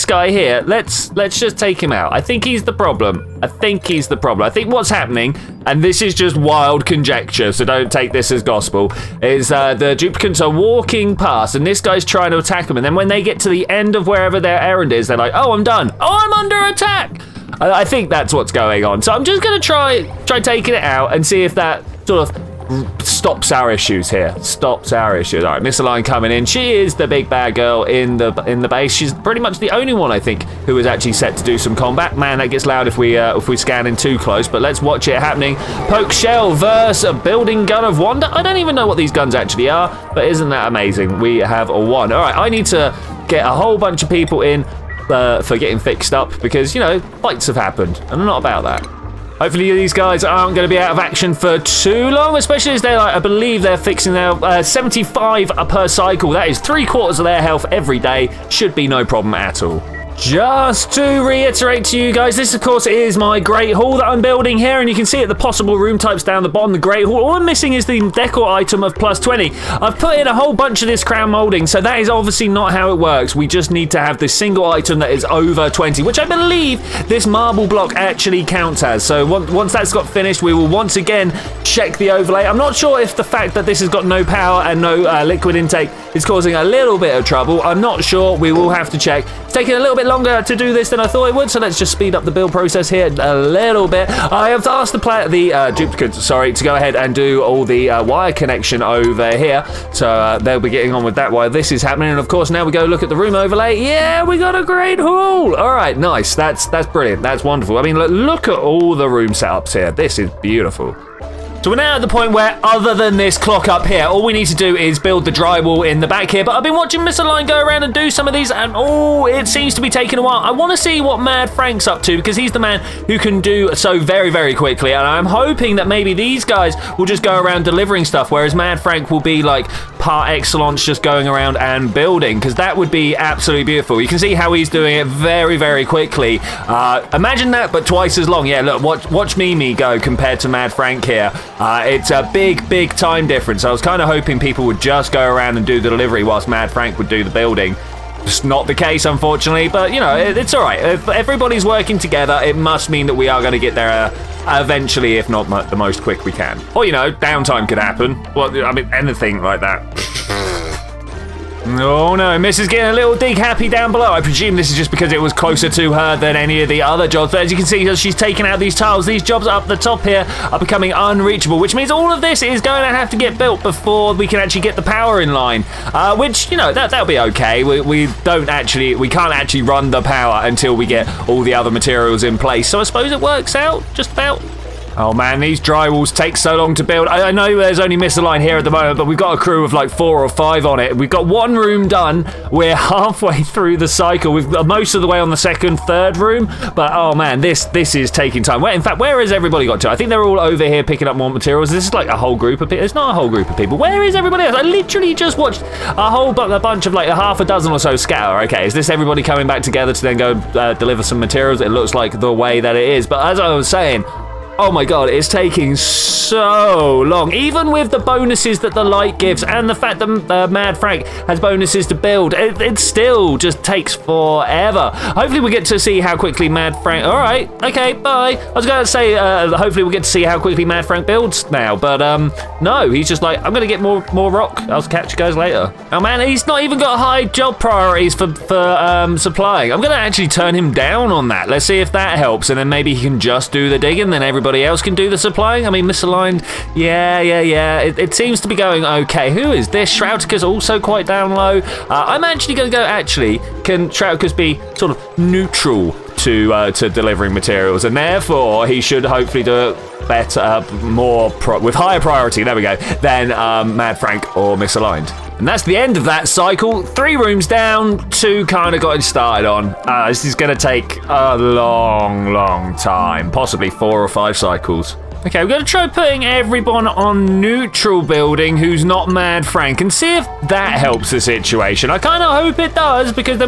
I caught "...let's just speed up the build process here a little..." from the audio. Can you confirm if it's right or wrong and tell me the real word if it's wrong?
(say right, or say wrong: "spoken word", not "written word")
right.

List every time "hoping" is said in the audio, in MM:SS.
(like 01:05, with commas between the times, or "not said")
02:05, 02:24.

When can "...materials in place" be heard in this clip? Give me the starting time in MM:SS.
03:01.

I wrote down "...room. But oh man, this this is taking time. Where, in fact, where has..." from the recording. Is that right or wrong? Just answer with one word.
right.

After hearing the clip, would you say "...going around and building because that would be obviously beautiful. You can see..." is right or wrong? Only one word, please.
wrong.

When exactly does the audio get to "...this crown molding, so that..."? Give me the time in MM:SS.
01:10.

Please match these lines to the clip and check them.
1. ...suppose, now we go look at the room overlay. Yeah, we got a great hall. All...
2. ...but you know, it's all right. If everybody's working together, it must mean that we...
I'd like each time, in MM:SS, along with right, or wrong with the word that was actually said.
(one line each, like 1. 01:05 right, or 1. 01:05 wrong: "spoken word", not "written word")
1. 01:42 wrong: "course", not "suppose"
2. 02:29 right.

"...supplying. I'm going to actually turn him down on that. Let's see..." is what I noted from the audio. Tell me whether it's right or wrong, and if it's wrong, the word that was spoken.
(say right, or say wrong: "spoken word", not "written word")
right.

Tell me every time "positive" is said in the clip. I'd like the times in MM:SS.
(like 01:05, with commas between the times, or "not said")
not said.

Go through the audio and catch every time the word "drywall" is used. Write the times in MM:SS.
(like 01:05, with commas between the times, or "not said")
01:55, 03:05.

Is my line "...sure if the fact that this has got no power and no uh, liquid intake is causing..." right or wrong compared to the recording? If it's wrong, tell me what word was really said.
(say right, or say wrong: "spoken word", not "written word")
right.